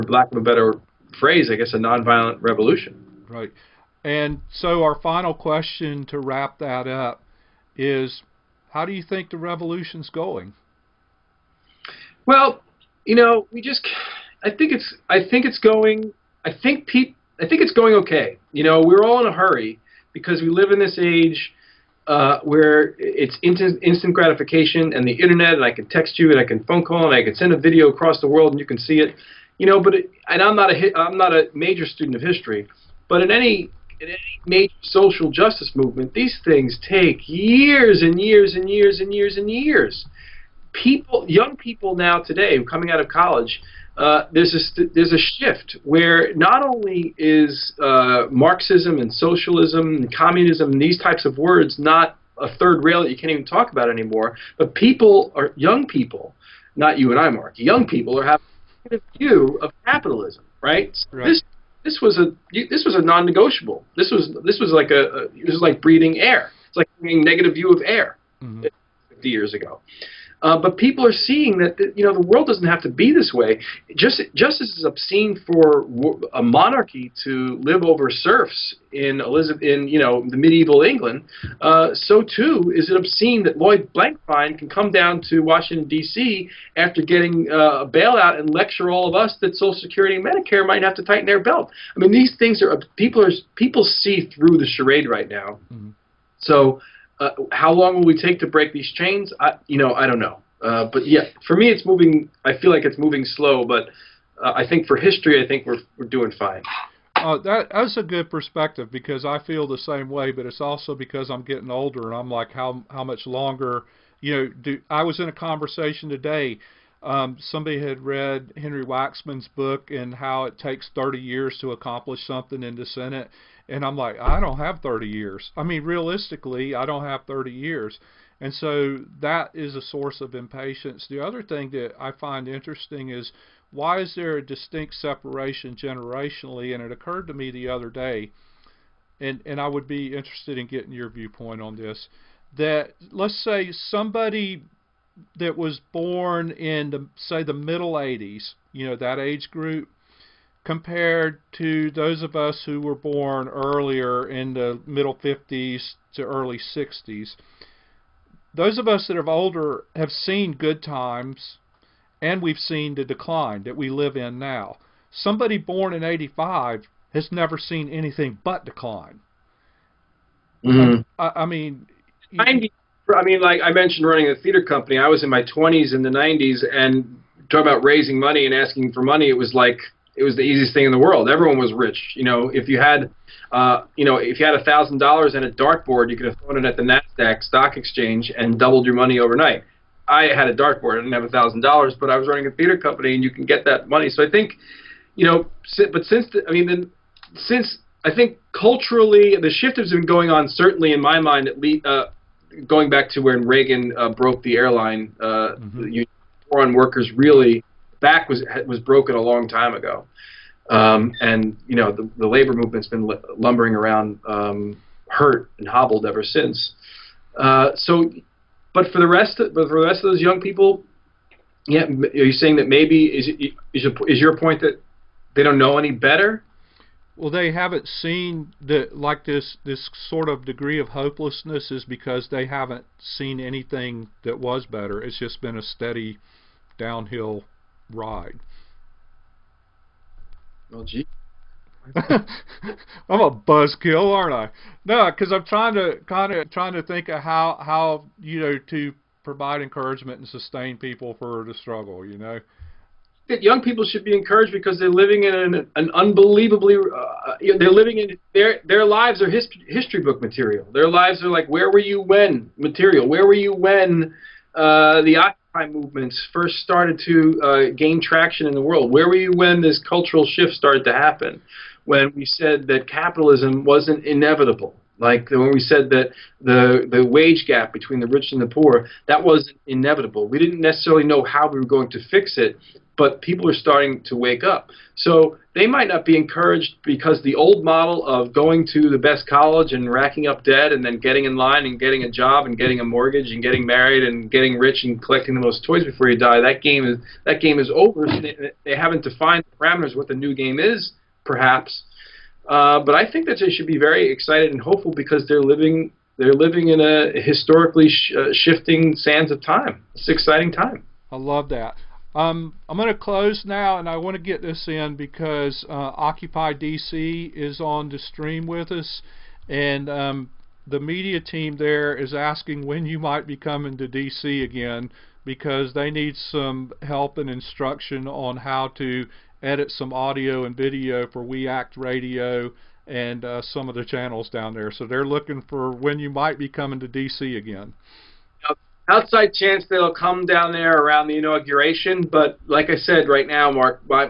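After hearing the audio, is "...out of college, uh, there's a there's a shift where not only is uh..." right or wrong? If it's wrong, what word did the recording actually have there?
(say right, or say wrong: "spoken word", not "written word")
right.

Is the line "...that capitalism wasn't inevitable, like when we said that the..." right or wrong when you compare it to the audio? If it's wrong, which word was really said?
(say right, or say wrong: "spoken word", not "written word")
right.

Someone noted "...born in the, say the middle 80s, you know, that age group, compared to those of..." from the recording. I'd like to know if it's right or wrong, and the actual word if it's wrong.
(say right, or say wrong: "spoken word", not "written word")
right.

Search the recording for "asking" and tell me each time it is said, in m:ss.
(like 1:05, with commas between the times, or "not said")
2:58, 5:22.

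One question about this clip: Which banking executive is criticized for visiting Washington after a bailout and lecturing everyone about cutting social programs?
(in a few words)
Lloyd Blankfein.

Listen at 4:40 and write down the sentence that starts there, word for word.
We didn't necessarily know how we were going to fix it, but people are starting to wake up.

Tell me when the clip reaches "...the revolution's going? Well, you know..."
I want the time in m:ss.
0:09.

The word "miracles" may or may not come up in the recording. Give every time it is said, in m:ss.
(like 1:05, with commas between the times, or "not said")
not said.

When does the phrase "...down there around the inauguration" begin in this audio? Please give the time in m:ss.
5:40.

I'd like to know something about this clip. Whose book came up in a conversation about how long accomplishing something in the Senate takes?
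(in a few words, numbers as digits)
Henry Waxman.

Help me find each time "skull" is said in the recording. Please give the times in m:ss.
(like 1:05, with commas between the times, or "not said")
not said.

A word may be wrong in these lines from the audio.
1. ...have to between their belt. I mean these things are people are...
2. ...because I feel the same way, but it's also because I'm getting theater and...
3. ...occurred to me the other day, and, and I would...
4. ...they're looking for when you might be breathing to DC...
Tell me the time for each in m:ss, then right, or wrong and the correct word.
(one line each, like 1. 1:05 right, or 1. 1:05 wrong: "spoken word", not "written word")
1. 1:30 wrong: "tighten", not "between"
2. 1:48 wrong: "older", not "theater"
3. 2:16 right
4. 5:34 wrong: "coming", not "breathing".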